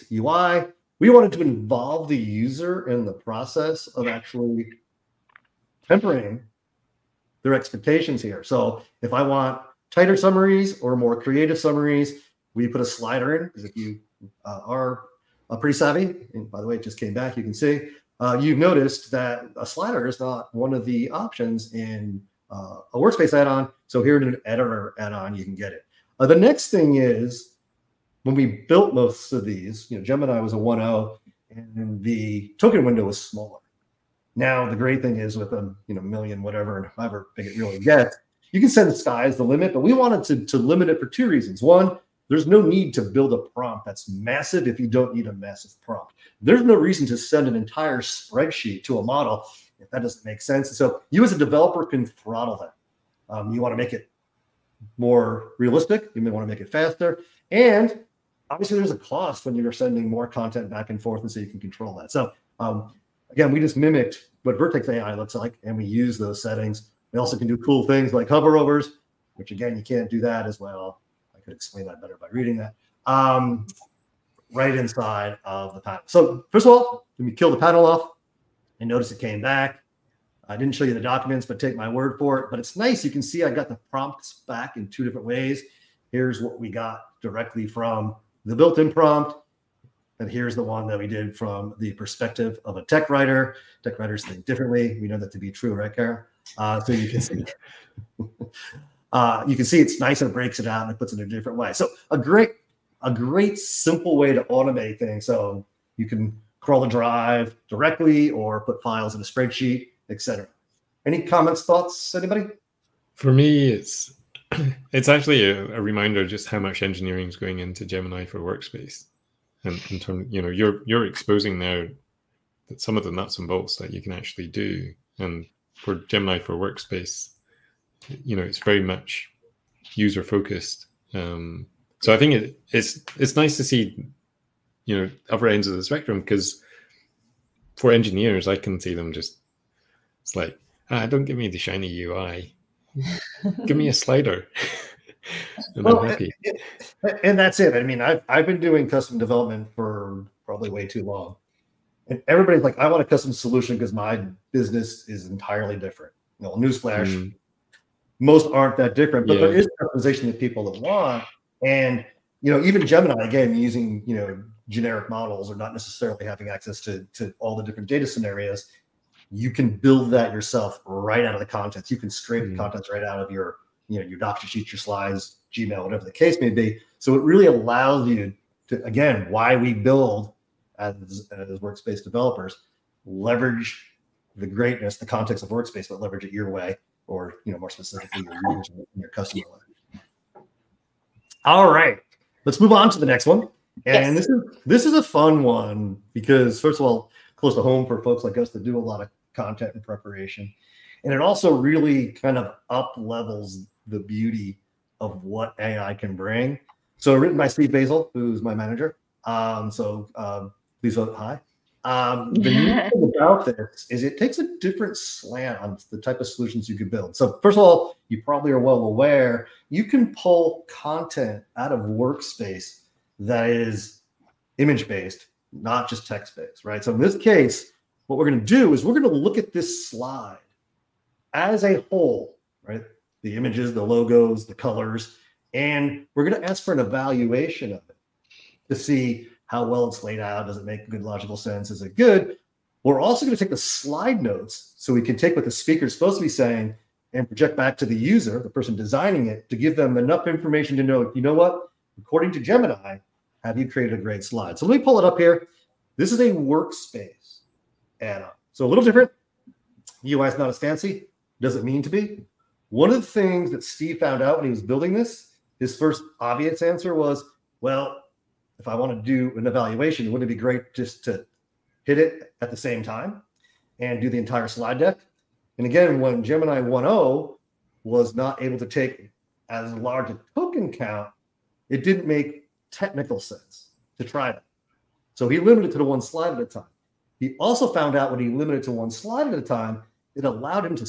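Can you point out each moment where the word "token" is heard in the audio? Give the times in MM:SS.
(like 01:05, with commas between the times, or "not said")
00:32, 04:40.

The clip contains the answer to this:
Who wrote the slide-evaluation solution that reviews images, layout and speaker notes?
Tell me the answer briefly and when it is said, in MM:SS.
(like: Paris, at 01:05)
Steve Bazyl, at 03:27.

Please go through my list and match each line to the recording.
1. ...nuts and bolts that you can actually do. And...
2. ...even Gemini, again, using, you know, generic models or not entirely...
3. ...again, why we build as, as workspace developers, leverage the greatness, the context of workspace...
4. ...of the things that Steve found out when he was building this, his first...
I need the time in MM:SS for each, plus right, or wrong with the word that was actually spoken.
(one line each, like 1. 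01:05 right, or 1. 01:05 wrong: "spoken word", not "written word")
1. 02:03 right
2. 02:42 wrong: "necessarily", not "entirely"
3. 02:58 right
4. 04:22 right.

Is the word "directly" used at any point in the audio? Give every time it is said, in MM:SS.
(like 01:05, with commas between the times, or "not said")
01:27, 01:47.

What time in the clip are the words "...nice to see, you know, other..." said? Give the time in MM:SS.
02:13.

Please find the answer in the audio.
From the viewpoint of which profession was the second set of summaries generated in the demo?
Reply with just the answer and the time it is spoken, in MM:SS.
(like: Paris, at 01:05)
tech writer, at 01:32.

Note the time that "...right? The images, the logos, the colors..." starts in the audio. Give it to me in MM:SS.
03:52.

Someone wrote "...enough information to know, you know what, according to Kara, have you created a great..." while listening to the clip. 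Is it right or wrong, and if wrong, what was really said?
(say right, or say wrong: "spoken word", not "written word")
wrong: "Gemini", not "Kara".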